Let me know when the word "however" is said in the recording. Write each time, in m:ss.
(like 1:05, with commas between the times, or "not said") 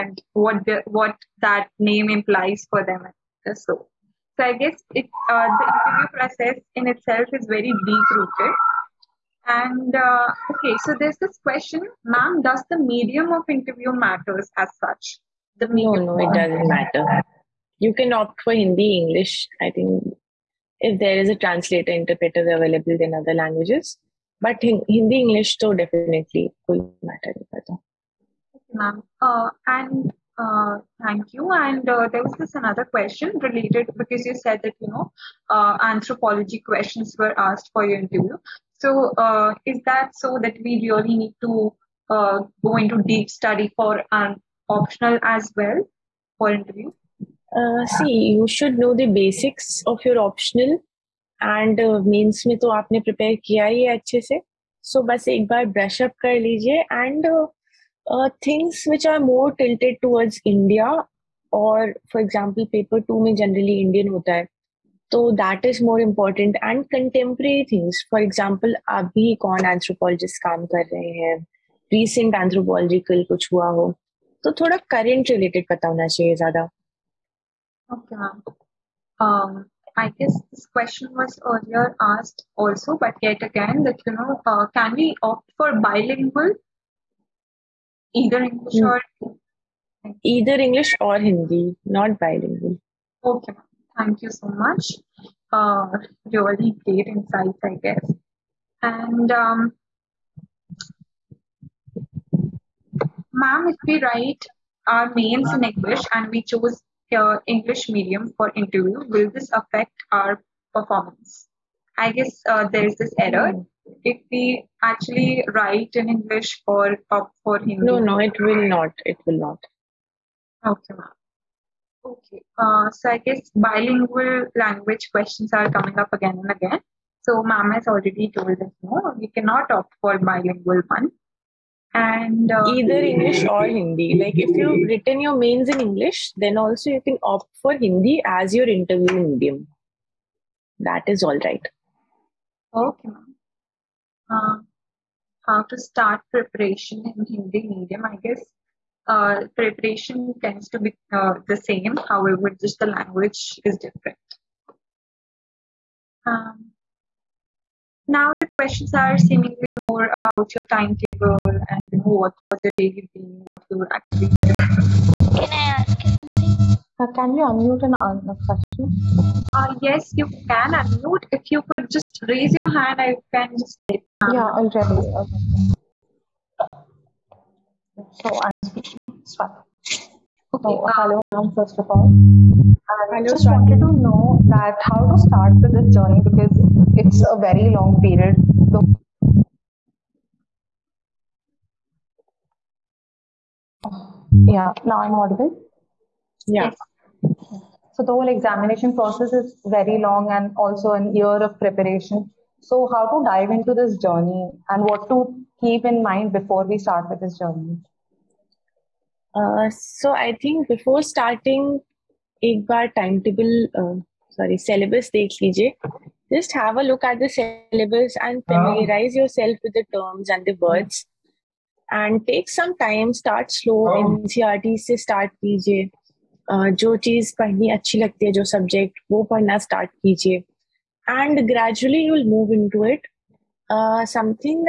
2:32.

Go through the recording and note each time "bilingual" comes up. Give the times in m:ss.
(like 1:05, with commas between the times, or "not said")
1:25, 1:32, 2:03, 2:10.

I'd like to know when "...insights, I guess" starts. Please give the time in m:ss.
1:37.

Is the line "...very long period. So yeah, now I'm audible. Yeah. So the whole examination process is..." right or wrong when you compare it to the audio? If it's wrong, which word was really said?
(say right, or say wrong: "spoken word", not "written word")
right.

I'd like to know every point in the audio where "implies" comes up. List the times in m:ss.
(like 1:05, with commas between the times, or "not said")
0:02.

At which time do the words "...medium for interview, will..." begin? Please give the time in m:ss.
1:47.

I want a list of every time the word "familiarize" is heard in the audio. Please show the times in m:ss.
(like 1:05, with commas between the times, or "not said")
3:38.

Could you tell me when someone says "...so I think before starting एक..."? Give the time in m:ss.
3:29.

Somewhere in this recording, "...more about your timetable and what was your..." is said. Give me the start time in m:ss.
2:39.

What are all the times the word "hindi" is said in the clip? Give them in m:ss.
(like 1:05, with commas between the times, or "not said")
0:18, 0:24, 1:31, 1:57, 2:13, 2:17, 2:27.